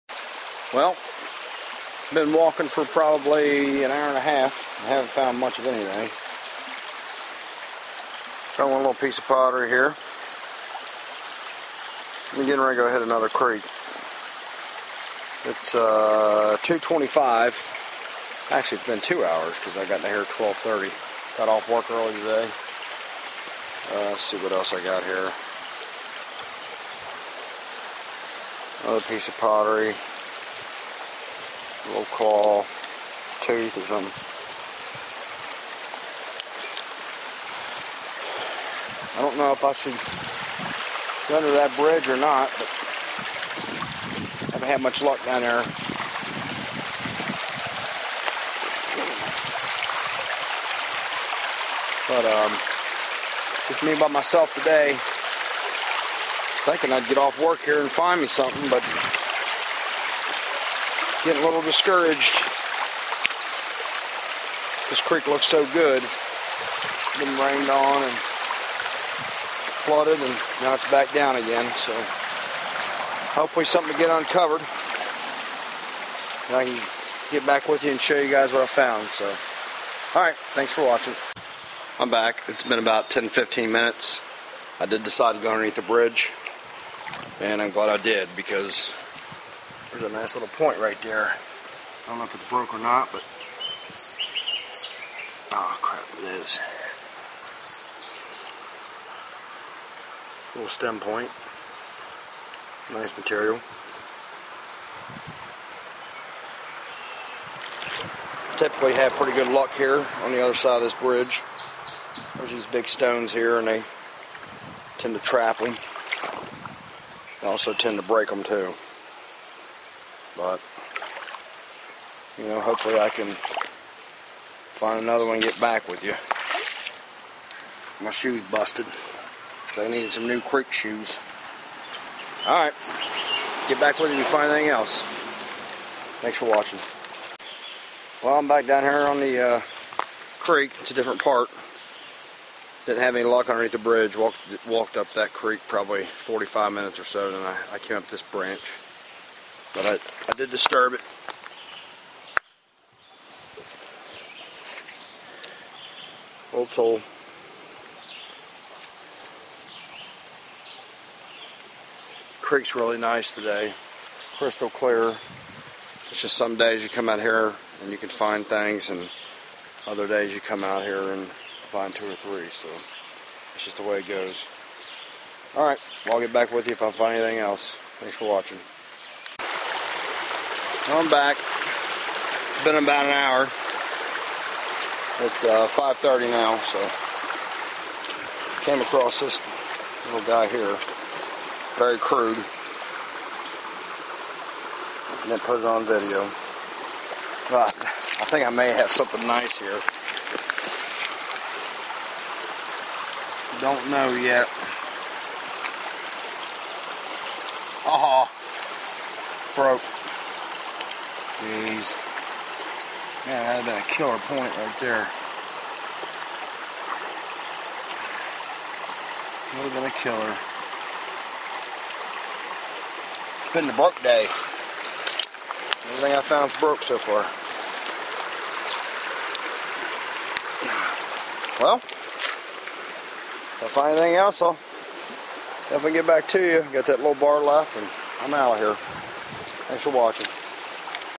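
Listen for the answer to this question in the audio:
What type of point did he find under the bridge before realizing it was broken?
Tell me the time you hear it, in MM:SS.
01:40.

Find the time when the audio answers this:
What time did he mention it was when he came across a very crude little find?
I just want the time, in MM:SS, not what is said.
03:05.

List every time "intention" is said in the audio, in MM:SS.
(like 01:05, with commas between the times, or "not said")
not said.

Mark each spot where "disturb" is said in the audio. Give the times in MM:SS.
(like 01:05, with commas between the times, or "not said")
02:30.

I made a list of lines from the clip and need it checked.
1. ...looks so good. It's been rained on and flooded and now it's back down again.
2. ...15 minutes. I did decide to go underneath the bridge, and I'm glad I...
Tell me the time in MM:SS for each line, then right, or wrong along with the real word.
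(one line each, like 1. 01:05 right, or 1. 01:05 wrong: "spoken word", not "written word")
1. 01:05 right
2. 01:23 right.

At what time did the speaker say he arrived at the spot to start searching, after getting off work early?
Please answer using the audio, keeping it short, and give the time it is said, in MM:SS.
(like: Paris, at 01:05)
12:30, at 00:20.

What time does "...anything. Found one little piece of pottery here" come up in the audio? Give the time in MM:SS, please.
00:05.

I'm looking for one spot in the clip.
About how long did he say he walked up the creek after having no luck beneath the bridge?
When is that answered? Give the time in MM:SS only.
02:26.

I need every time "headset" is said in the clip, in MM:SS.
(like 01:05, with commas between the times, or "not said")
not said.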